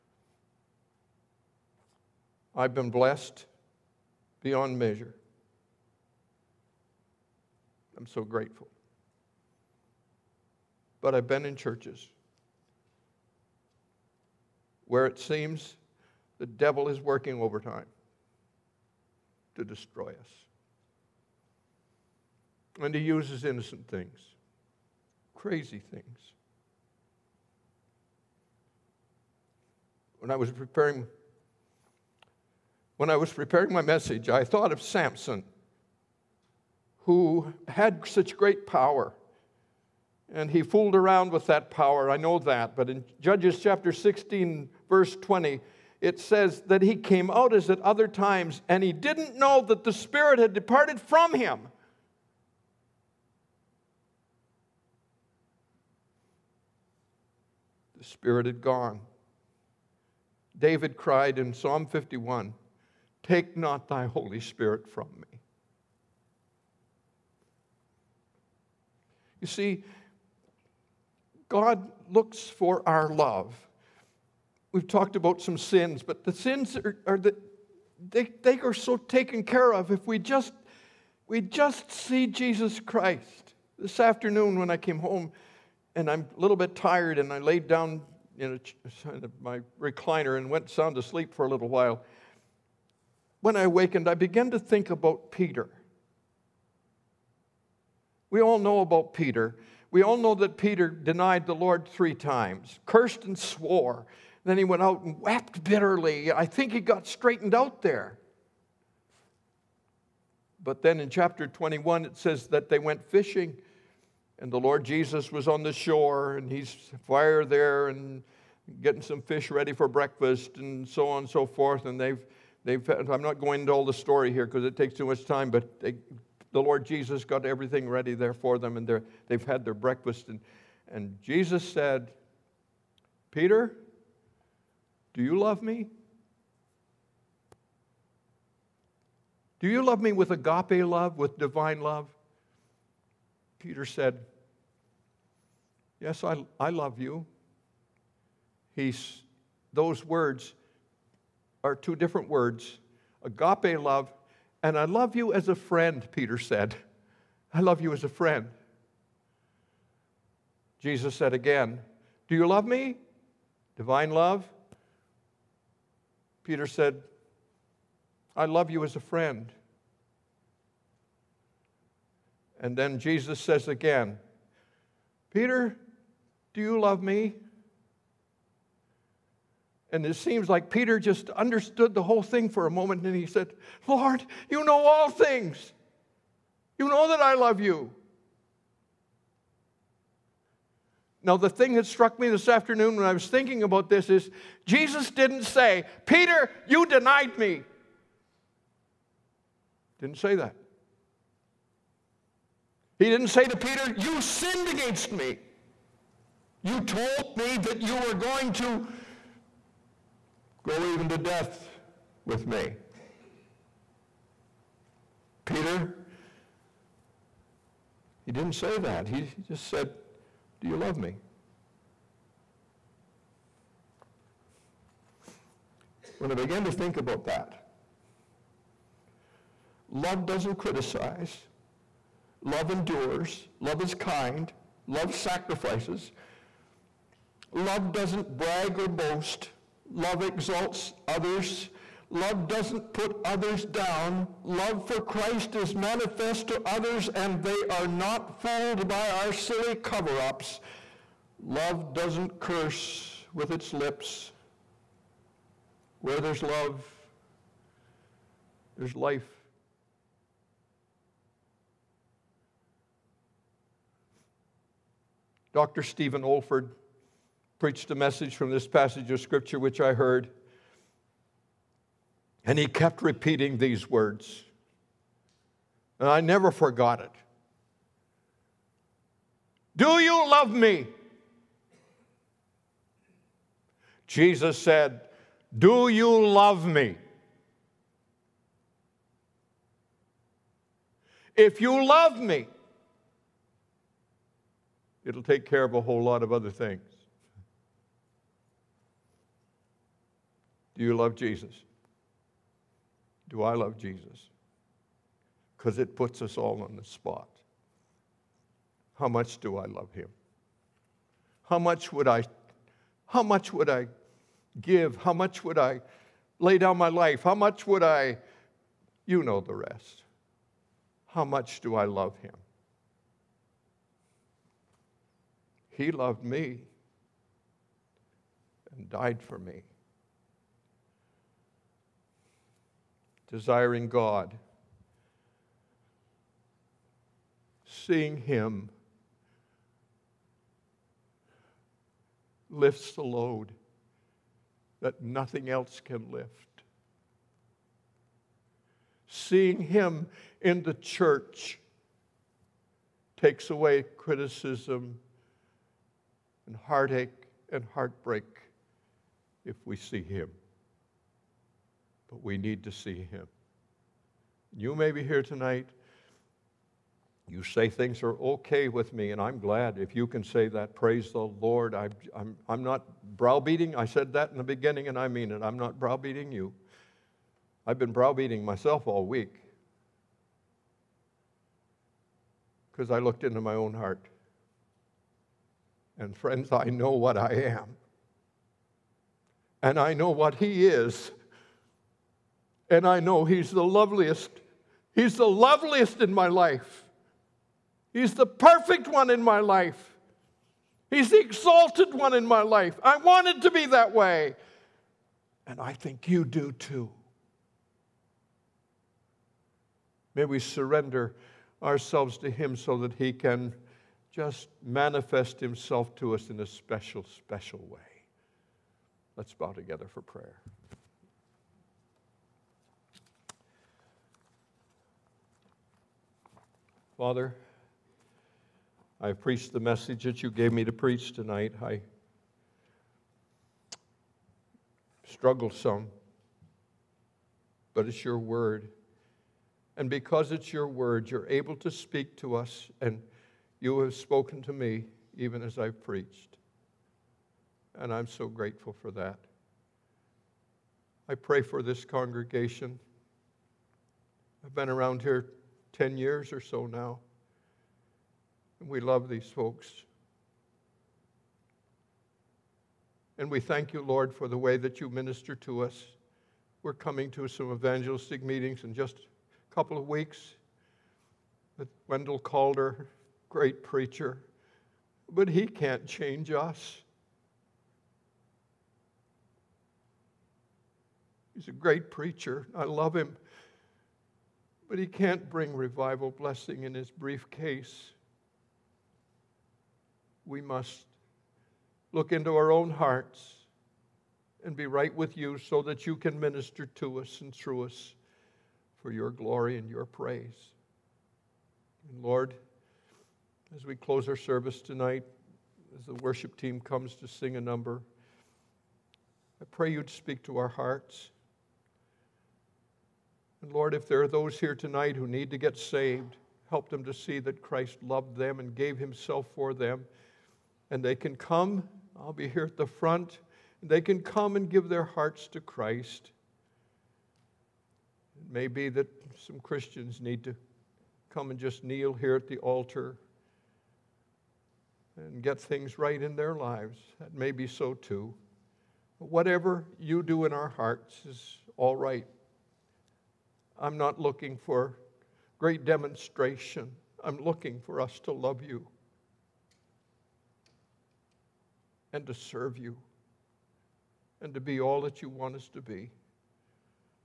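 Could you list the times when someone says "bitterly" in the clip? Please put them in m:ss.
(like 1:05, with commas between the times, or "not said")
1:45.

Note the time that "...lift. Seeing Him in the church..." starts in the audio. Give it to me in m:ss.
5:46.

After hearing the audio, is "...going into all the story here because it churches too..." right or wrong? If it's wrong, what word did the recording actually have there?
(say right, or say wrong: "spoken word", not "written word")
wrong: "takes", not "churches".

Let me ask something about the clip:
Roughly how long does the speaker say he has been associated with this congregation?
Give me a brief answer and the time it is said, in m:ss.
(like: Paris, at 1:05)
10 years, at 7:35.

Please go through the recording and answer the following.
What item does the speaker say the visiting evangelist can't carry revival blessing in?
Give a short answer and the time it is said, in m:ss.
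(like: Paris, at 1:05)
His briefcase, at 8:06.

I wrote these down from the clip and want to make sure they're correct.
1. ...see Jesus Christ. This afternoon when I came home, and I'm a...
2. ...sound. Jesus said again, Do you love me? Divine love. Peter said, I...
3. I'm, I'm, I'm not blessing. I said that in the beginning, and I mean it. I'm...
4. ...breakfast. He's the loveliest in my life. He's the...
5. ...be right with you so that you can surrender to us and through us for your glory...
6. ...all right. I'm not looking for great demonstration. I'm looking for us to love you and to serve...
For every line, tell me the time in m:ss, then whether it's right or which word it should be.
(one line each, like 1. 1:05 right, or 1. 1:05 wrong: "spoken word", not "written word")
1. 1:21 right
2. 2:38 wrong: "friend", not "sound"
3. 6:11 wrong: "browbeating", not "blessing"
4. 6:33 wrong: "loveliest", not "breakfast"
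5. 8:14 wrong: "minister", not "surrender"
6. 9:01 right.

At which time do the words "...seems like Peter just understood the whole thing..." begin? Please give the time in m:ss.
3:00.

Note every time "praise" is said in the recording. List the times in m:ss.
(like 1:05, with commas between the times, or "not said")
6:10, 8:19.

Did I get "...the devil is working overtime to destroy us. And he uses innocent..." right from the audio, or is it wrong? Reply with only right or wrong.
right.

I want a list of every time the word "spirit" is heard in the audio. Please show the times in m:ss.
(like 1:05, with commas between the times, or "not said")
0:49, 0:58, 1:04.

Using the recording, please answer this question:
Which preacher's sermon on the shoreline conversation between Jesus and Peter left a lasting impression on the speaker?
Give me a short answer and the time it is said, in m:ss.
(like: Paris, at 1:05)
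Stephen Olford, at 4:25.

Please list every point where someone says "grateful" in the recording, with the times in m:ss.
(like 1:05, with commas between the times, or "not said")
0:08, 7:28.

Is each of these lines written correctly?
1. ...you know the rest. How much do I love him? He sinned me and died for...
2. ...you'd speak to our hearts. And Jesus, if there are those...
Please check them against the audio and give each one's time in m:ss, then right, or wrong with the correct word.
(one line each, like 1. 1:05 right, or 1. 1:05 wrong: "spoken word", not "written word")
1. 5:19 wrong: "loved", not "sinned"
2. 8:29 wrong: "Lord", not "Jesus".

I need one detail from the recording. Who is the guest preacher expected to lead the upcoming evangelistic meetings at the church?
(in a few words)
Wendell Calder.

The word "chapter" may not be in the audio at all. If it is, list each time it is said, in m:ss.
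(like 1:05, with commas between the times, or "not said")
0:43, 1:51.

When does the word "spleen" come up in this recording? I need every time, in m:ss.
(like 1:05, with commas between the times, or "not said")
not said.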